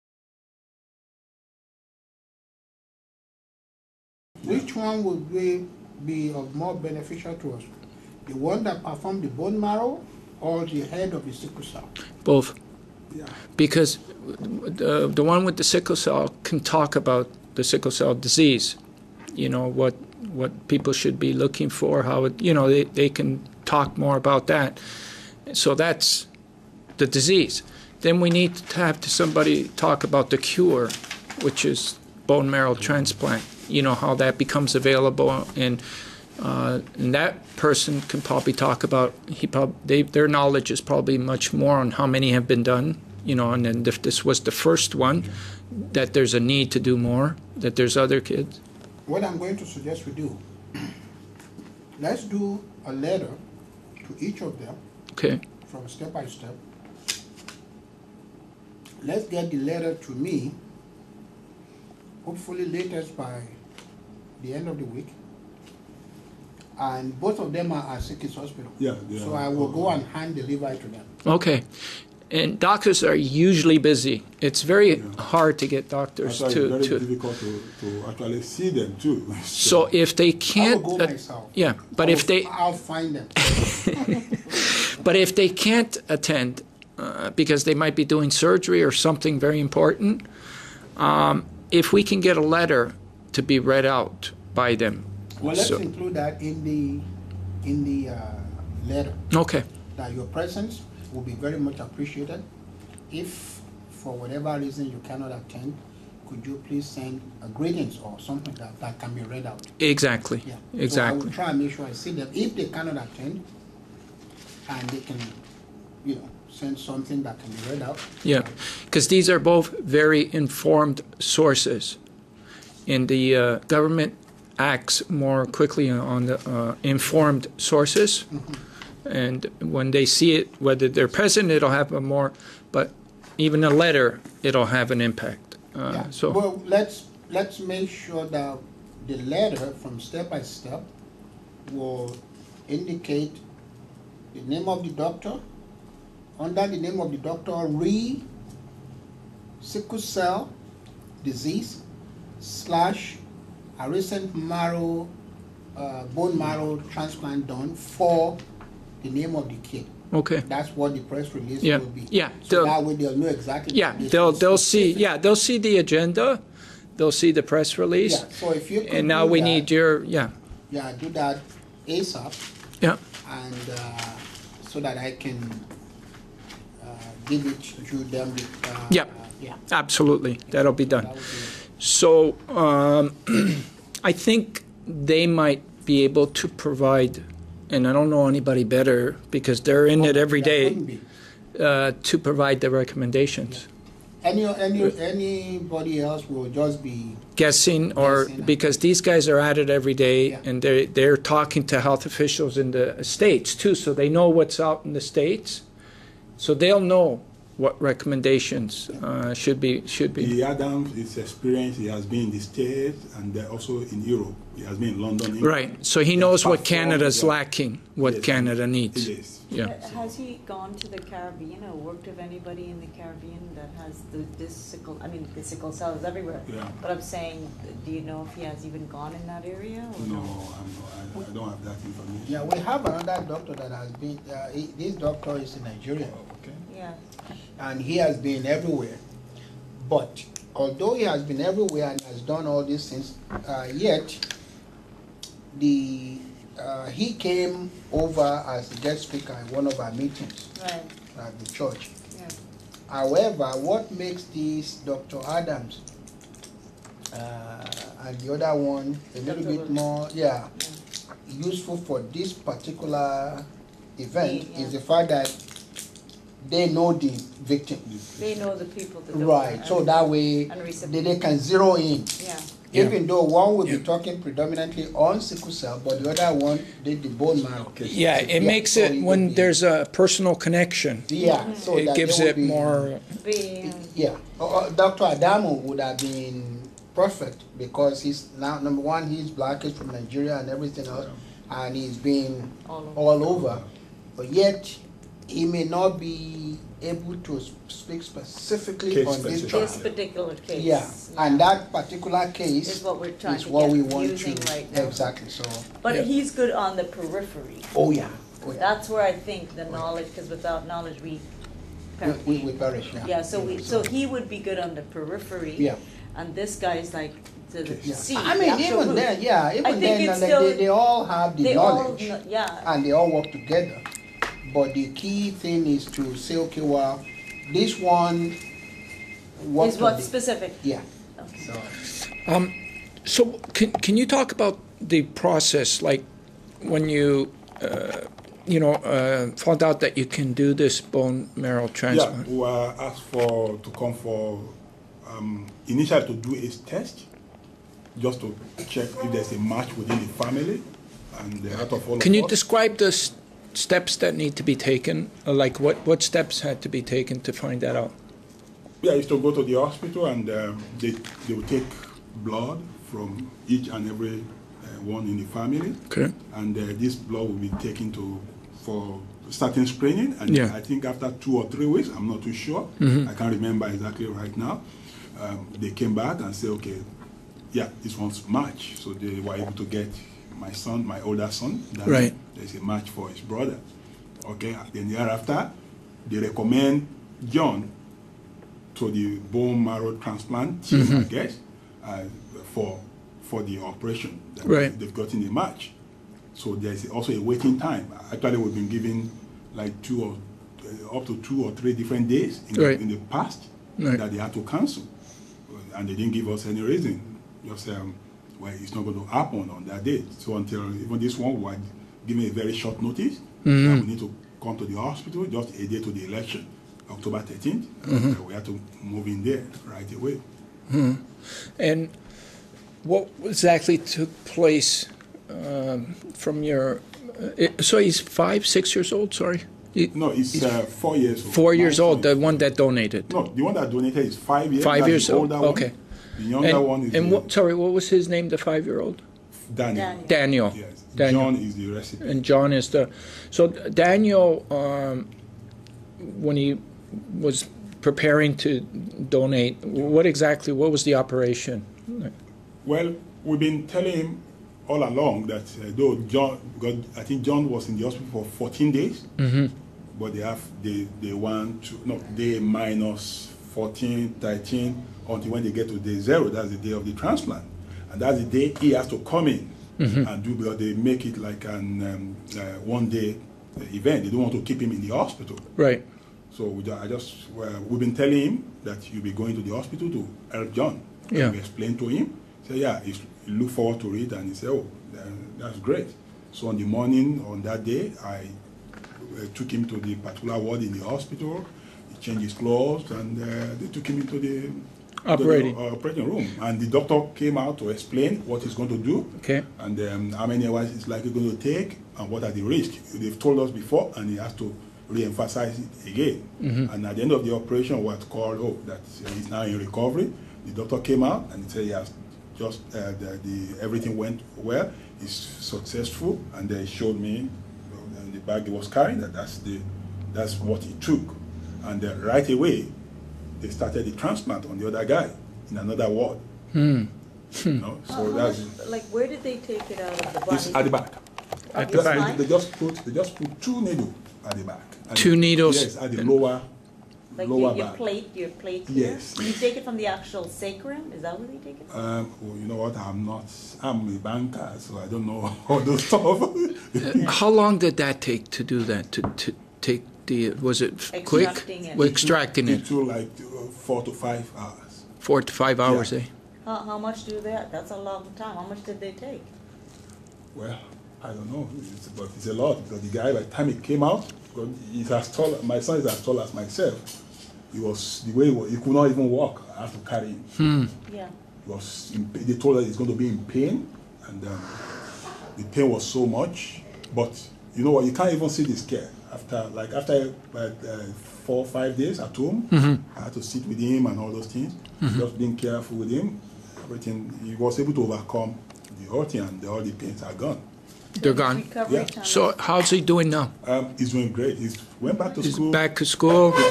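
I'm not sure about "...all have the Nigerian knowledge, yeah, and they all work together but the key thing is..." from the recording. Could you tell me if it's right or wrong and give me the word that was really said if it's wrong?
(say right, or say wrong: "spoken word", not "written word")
wrong: "They", not "Nigerian".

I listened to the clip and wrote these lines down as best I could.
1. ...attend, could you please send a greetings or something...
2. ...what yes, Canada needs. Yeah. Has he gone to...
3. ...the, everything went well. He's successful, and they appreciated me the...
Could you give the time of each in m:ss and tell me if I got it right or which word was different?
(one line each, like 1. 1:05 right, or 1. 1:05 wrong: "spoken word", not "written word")
1. 1:45 right
2. 3:37 right
3. 8:33 wrong: "showed", not "appreciated".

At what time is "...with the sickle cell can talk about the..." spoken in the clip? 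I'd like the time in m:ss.
0:15.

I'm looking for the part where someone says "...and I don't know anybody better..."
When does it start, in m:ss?
3:07.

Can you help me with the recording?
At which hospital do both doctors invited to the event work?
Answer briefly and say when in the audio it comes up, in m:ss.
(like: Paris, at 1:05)
SickKids Hospital, at 1:08.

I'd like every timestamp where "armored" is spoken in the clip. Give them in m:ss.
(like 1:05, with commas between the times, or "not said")
not said.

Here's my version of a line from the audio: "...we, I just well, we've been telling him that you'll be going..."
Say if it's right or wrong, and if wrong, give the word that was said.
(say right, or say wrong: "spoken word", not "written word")
right.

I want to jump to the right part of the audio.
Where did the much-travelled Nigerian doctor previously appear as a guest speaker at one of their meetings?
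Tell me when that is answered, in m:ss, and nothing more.
4:11.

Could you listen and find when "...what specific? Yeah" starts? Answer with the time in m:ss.
5:29.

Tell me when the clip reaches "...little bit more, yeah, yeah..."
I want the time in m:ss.
4:19.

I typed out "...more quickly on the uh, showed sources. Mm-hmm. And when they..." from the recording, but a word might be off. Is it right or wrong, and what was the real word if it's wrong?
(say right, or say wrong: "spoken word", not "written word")
wrong: "informed", not "showed".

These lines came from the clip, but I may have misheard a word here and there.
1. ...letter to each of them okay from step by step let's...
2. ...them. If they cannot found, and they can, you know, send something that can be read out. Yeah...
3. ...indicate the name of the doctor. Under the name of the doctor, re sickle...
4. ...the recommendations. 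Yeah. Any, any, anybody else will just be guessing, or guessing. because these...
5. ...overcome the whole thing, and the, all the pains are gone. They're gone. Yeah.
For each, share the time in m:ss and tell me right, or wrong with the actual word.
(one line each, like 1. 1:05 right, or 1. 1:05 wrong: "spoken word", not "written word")
1. 0:52 right
2. 1:52 wrong: "attend", not "found"
3. 2:22 right
4. 3:12 right
5. 9:47 right.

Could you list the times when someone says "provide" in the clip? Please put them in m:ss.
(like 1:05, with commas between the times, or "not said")
3:06, 3:12.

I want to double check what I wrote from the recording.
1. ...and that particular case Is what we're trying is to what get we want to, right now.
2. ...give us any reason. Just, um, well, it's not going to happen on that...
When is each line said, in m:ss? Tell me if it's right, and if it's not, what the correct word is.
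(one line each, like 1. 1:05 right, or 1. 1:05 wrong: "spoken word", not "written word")
1. 5:01 right
2. 6:46 right.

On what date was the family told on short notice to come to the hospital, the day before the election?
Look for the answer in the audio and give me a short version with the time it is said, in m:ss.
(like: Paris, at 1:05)
October 13, at 6:56.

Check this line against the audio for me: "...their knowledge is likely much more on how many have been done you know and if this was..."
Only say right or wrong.
wrong.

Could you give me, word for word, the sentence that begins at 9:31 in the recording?
In, they told us he's going to be in pain, and um, the pain was so much.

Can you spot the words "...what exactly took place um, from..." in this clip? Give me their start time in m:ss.
7:02.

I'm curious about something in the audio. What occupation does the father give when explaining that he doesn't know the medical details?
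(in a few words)
Banker.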